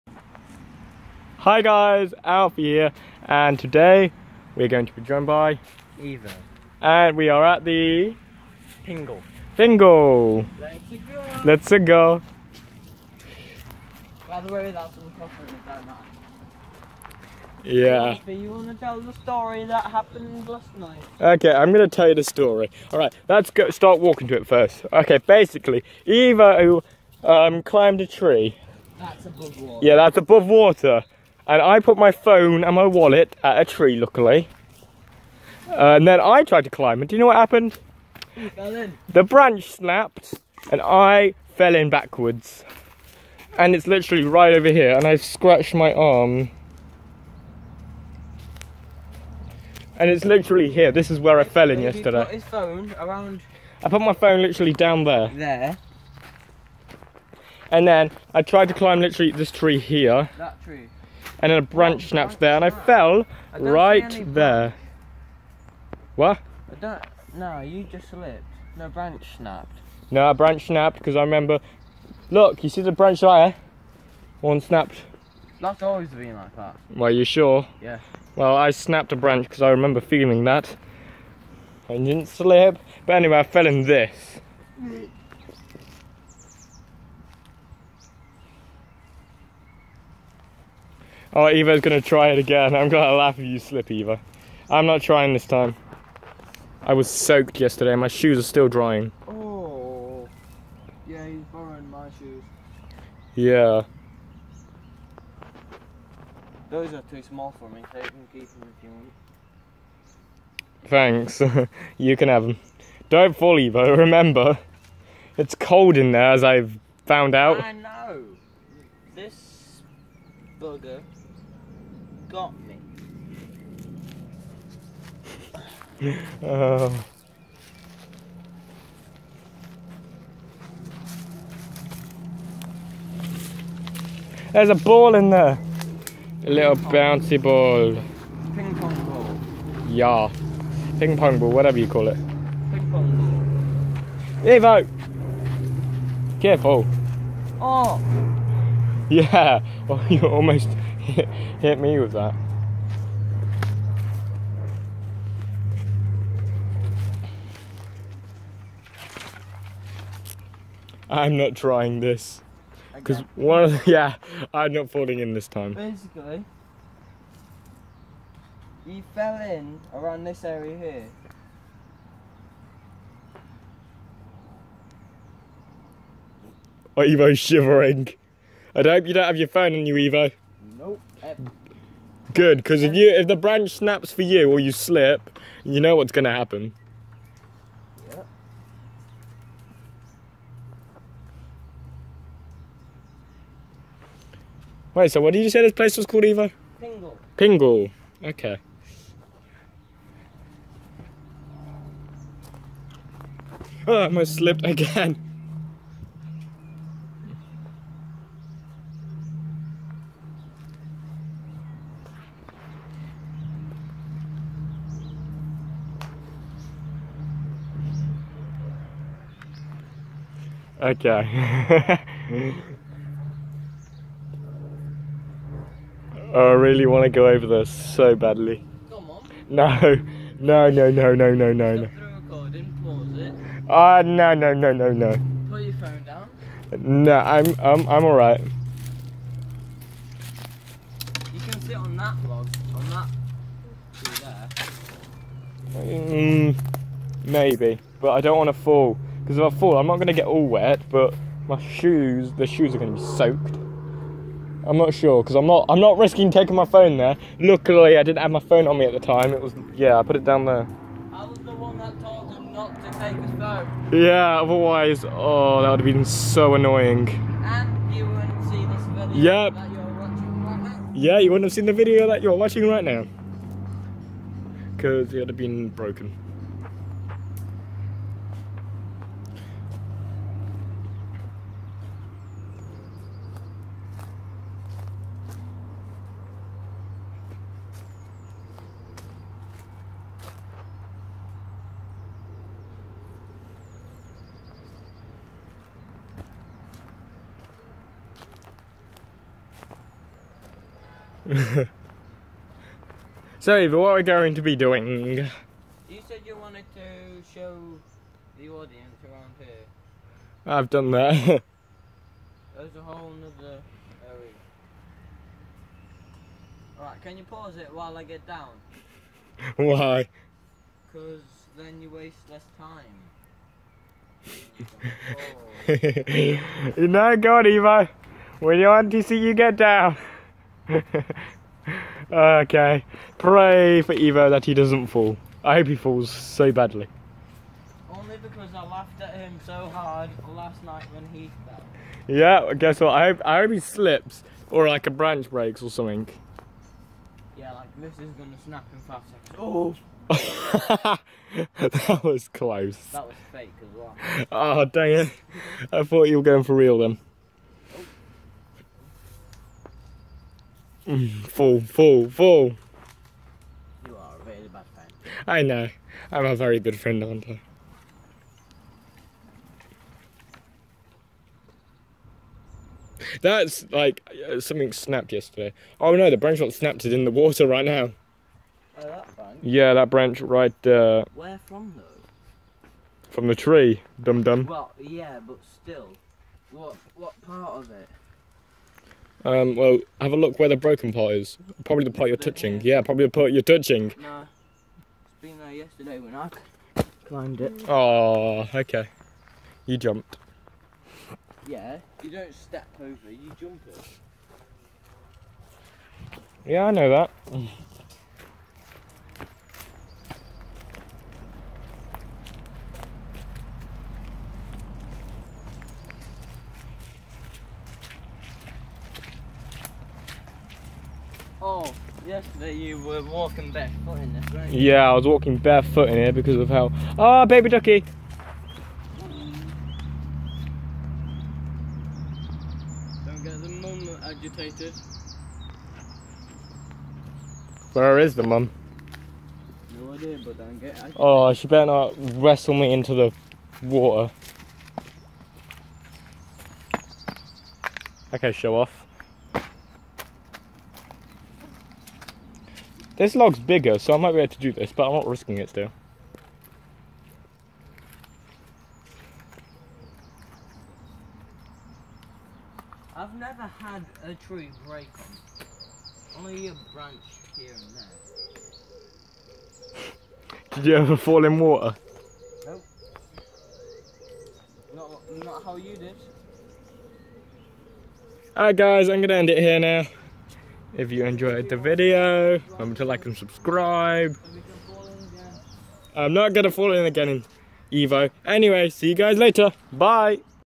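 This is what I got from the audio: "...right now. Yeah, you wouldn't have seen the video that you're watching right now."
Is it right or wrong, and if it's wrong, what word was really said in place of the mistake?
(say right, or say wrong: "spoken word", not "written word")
right.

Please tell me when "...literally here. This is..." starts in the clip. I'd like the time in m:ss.
0:50.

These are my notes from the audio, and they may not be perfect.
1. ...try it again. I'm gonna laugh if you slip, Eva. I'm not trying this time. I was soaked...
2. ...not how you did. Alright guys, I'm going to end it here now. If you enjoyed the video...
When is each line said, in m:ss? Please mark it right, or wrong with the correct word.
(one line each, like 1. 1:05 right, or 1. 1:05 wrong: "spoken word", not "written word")
1. 1:32 right
2. 7:55 right.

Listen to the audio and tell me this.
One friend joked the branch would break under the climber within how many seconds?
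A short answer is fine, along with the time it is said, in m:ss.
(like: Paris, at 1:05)
5, at 5:48.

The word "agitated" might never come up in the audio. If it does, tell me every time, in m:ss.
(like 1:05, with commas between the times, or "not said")
7:14, 7:20.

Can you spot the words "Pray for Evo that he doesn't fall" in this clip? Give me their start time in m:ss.
5:33.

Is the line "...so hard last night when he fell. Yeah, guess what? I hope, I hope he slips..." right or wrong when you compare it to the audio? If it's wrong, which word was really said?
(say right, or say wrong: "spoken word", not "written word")
right.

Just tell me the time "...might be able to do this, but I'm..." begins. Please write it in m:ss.
7:33.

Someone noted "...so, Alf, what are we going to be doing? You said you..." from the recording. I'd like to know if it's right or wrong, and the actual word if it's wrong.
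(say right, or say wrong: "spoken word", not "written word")
wrong: "Eva", not "Alf".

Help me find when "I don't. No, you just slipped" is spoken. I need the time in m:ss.
1:06.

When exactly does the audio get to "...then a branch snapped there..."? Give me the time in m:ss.
1:01.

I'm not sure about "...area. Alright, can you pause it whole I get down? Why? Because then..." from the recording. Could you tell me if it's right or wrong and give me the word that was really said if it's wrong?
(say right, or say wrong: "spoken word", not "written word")
wrong: "while", not "whole".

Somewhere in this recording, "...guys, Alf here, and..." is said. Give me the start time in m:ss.
0:01.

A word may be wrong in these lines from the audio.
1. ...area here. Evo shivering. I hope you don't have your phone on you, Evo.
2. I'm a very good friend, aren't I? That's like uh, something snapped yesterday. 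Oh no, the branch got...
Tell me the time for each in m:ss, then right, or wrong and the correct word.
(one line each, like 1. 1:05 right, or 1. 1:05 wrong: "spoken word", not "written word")
1. 2:50 right
2. 6:06 right.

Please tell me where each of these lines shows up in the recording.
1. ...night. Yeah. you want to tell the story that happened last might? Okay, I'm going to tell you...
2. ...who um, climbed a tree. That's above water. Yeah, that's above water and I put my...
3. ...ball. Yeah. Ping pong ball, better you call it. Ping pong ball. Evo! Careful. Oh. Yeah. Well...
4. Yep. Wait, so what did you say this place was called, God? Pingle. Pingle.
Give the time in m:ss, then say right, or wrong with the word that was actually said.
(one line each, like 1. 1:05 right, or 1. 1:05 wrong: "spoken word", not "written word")
1. 0:15 wrong: "night", not "might"
2. 0:26 right
3. 2:19 wrong: "whatever", not "better"
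4. 3:08 wrong: "Evo", not "God".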